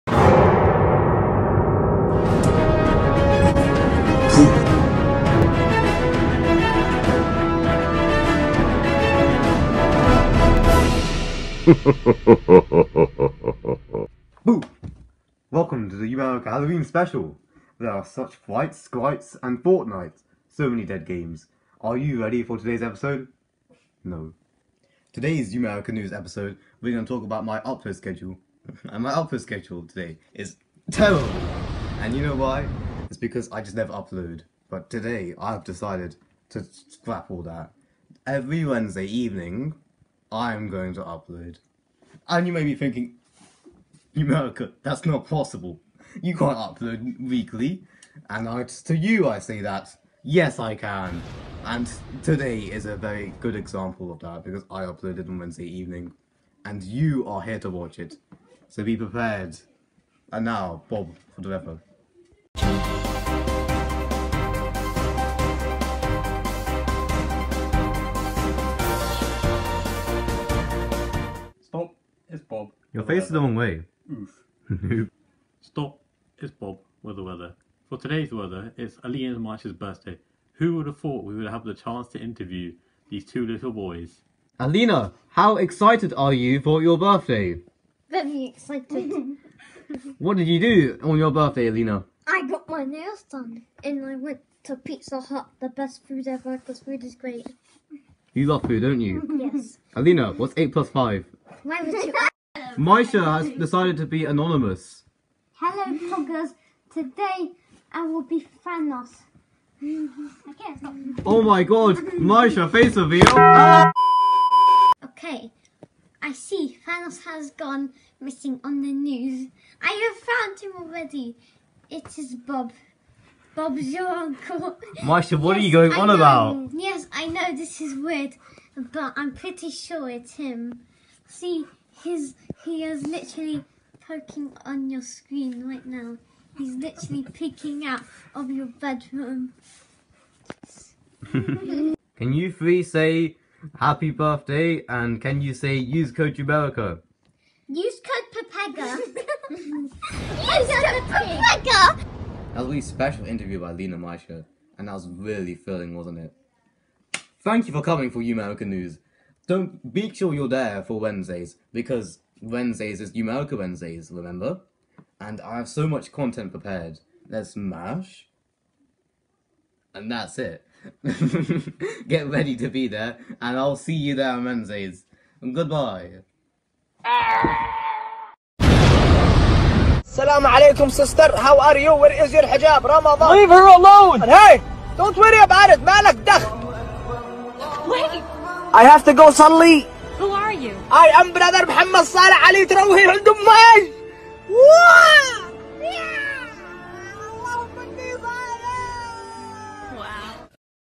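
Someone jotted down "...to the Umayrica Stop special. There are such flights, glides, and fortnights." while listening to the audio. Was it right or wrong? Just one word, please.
wrong.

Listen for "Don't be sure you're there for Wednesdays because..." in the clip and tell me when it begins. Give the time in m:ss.
2:39.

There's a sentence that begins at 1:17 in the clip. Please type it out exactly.
For today's weather, it's Alien March's birthday.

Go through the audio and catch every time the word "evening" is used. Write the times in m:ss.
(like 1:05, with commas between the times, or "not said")
0:39, 0:55.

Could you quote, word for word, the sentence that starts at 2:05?
Mysha, what yes, are you going on about?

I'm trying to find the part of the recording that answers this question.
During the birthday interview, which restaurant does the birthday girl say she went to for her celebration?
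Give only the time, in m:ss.
1:34.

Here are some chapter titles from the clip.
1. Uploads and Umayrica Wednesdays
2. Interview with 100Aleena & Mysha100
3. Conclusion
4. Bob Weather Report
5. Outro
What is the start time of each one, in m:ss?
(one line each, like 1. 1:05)
1. 0:24
2. 1:25
3. 2:32
4. 1:02
5. 3:00.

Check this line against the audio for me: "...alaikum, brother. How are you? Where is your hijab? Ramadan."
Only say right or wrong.
wrong.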